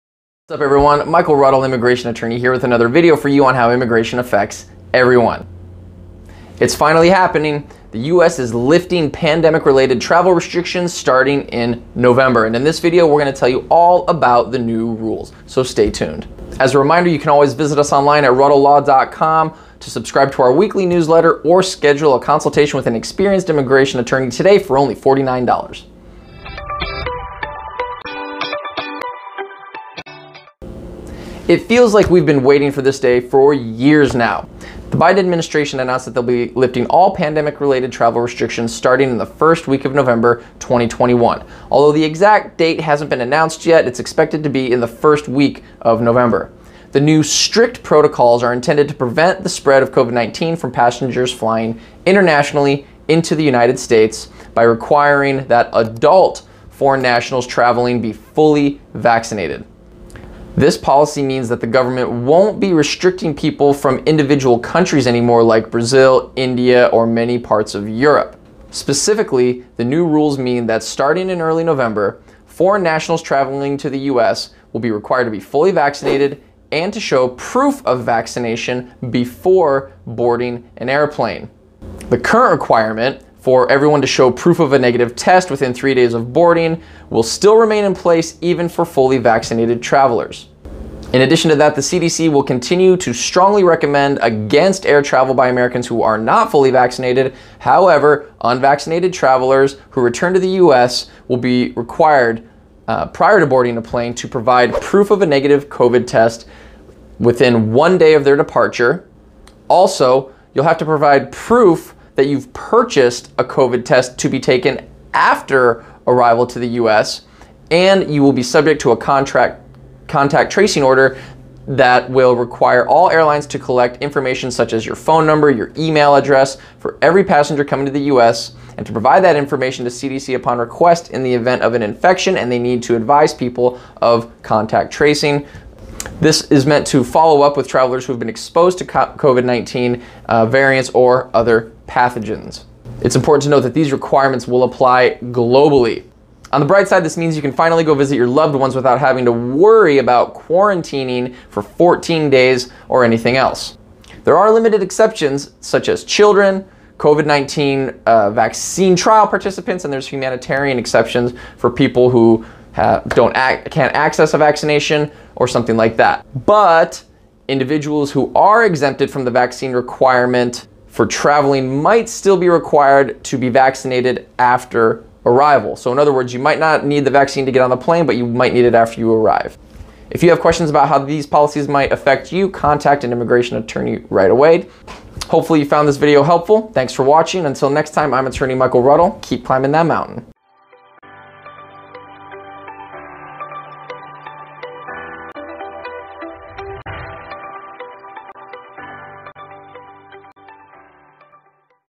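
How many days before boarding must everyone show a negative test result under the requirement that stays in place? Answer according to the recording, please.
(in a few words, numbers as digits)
3.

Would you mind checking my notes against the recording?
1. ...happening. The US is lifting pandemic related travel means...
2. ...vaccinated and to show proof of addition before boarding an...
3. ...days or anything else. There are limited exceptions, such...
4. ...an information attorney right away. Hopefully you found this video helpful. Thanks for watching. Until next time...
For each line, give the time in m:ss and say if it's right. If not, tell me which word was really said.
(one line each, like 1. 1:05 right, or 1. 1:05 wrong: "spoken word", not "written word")
1. 0:07 wrong: "restrictions", not "means"
2. 1:15 wrong: "vaccination", not "addition"
3. 2:32 right
4. 3:03 wrong: "immigration", not "information".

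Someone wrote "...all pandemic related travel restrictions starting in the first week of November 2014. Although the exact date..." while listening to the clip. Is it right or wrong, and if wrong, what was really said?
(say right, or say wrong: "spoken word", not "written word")
wrong: "2021", not "2014".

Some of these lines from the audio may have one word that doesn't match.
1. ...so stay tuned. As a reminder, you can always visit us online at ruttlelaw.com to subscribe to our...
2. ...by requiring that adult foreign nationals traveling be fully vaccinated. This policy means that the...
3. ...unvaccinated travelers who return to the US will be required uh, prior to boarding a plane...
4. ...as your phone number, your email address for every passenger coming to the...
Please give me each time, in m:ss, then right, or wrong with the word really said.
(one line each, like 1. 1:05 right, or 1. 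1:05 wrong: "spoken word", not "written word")
1. 0:15 right
2. 0:54 right
3. 1:38 right
4. 2:04 right.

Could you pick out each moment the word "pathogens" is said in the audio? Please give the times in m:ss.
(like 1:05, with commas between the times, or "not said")
2:21.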